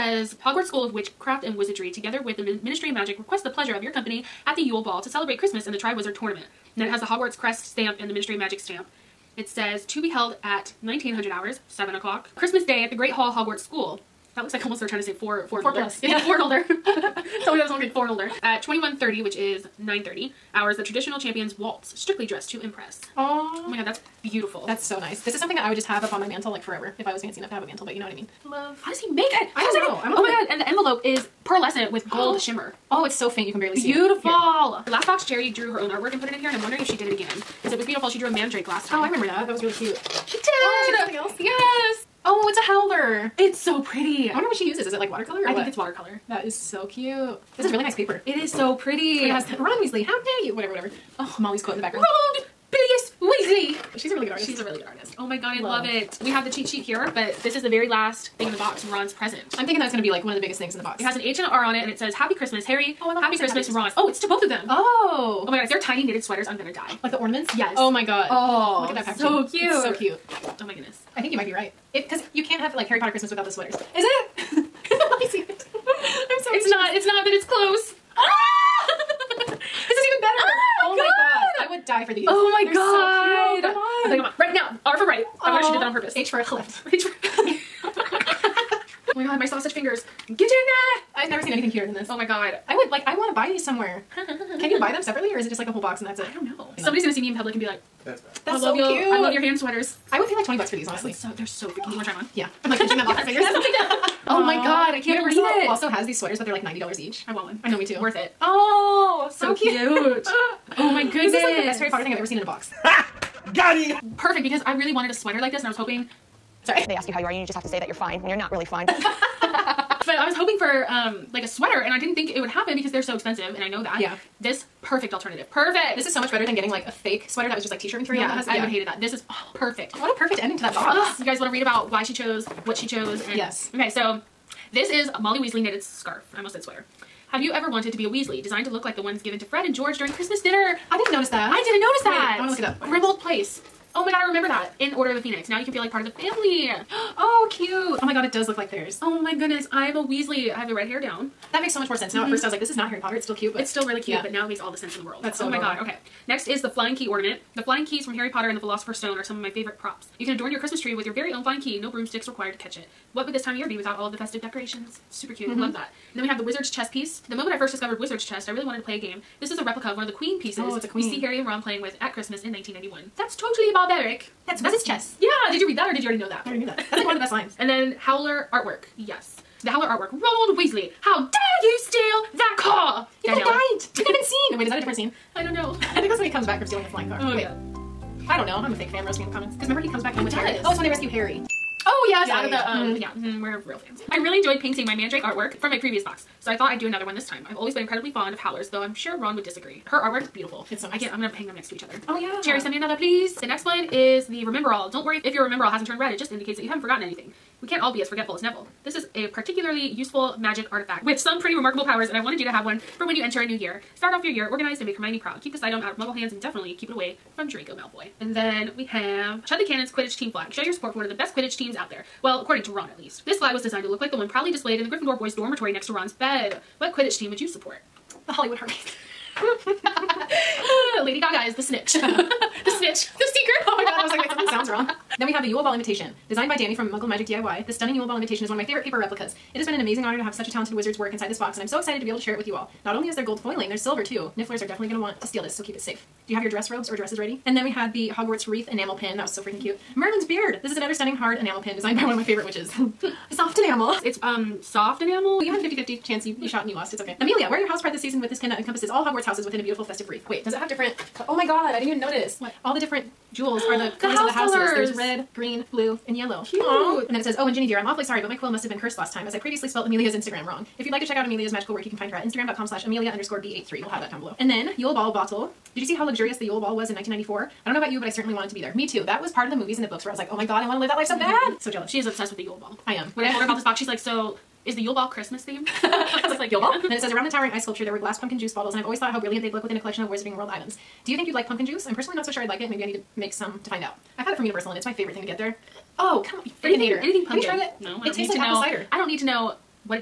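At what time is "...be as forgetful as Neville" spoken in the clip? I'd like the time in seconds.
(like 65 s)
207 s.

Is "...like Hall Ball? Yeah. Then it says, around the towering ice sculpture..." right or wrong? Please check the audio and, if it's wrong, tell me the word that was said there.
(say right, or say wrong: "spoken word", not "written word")
wrong: "Yule", not "Hall".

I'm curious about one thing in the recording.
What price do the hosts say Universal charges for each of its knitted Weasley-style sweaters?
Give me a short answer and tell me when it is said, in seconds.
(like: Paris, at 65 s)
$90, at 106 s.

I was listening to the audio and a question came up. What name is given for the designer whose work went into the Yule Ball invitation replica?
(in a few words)
Danny.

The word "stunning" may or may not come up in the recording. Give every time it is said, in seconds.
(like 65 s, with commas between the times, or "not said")
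237 s, 250 s.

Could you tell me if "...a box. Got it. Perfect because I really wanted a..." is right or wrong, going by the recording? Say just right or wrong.
right.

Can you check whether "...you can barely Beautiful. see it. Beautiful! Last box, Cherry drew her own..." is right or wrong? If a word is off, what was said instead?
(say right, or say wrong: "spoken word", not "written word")
right.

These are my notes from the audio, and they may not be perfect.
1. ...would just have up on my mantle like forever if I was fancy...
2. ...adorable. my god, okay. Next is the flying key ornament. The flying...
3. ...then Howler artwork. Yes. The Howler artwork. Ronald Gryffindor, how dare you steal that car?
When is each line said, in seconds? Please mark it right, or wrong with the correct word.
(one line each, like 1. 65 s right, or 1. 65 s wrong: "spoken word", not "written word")
1. 25 s right
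2. 155 s right
3. 177 s wrong: "Weasley", not "Gryffindor".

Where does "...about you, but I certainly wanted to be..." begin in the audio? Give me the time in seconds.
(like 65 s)
277 s.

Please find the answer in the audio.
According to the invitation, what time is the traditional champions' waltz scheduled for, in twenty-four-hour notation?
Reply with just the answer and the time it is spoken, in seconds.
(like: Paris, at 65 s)
21.30, at 18 s.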